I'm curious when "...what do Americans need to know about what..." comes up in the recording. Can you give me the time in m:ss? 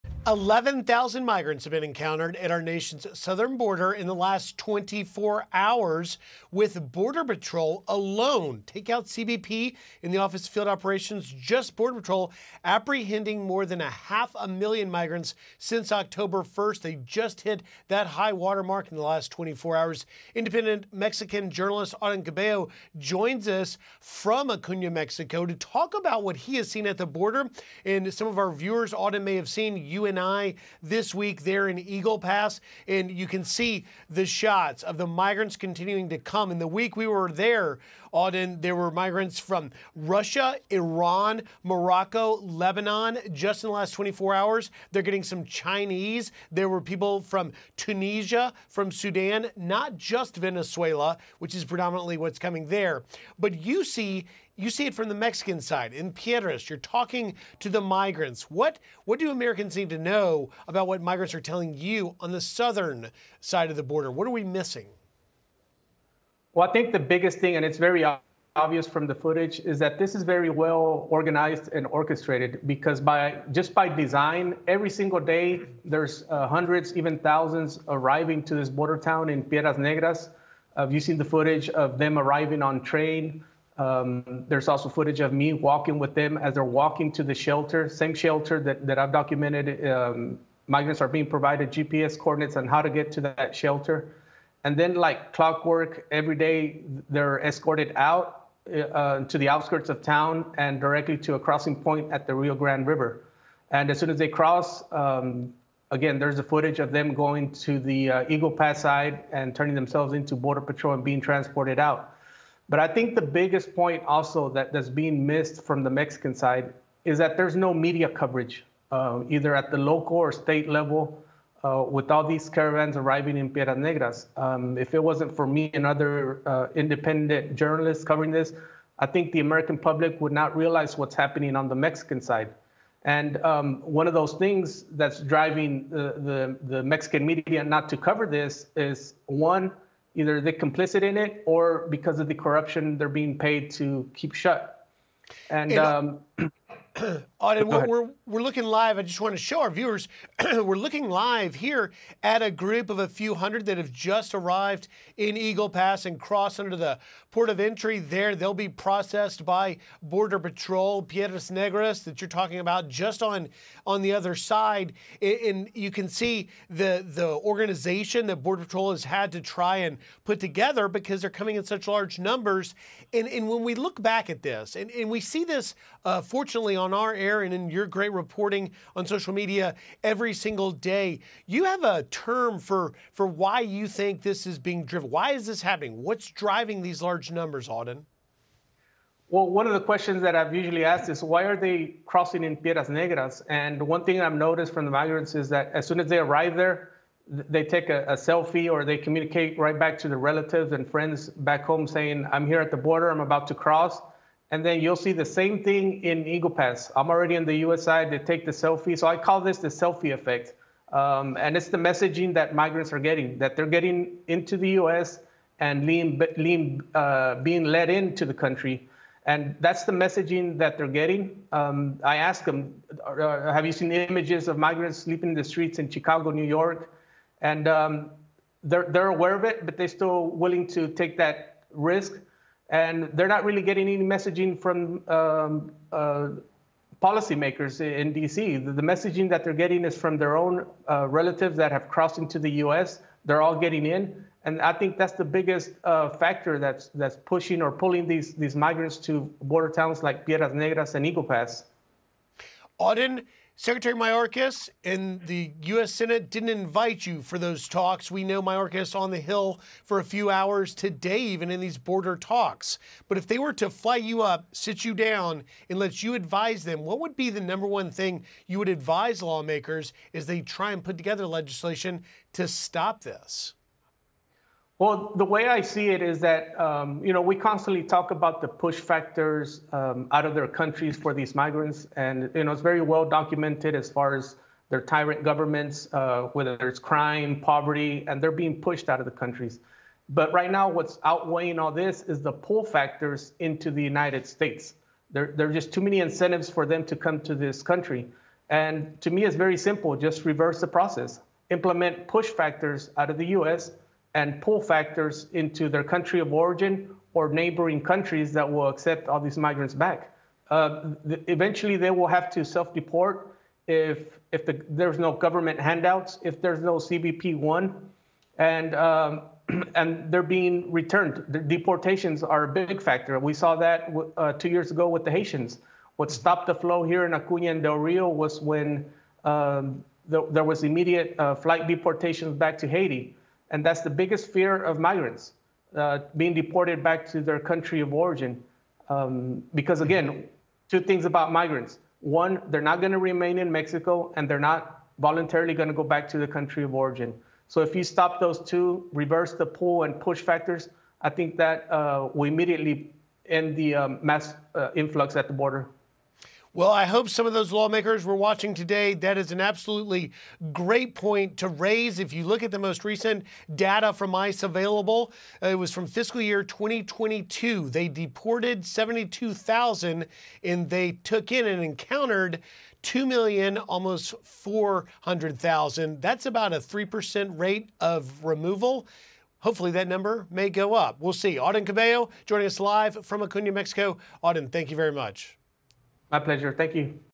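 0:59.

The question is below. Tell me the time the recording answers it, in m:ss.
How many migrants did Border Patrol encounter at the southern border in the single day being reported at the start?
0:00.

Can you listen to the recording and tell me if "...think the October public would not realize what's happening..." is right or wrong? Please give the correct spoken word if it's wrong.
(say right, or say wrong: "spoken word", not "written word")
wrong: "American", not "October".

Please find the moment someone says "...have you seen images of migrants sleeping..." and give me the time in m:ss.
3:43.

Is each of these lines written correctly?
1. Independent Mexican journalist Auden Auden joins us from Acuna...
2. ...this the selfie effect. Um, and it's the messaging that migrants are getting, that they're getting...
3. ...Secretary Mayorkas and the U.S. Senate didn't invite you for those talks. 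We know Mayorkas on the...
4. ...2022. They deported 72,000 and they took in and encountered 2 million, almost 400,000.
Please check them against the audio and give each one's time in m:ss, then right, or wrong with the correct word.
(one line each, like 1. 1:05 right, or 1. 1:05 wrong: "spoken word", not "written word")
1. 0:20 wrong: "Cabello", not "Auden"
2. 3:29 right
3. 4:13 right
4. 6:06 right.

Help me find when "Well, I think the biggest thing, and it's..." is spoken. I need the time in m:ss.
1:06.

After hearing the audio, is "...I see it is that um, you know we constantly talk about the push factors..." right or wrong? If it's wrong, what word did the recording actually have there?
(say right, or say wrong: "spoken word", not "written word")
right.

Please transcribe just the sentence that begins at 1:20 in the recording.
Uh, you've seen the footage of them arriving on train.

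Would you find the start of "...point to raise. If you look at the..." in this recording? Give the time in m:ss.
6:00.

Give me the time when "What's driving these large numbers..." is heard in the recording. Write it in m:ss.
3:06.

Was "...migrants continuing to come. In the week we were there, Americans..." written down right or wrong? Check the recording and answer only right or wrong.
wrong.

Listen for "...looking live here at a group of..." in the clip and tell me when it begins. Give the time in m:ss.
2:30.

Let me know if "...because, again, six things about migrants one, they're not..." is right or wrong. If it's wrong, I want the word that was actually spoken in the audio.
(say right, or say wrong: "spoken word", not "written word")
wrong: "two", not "six".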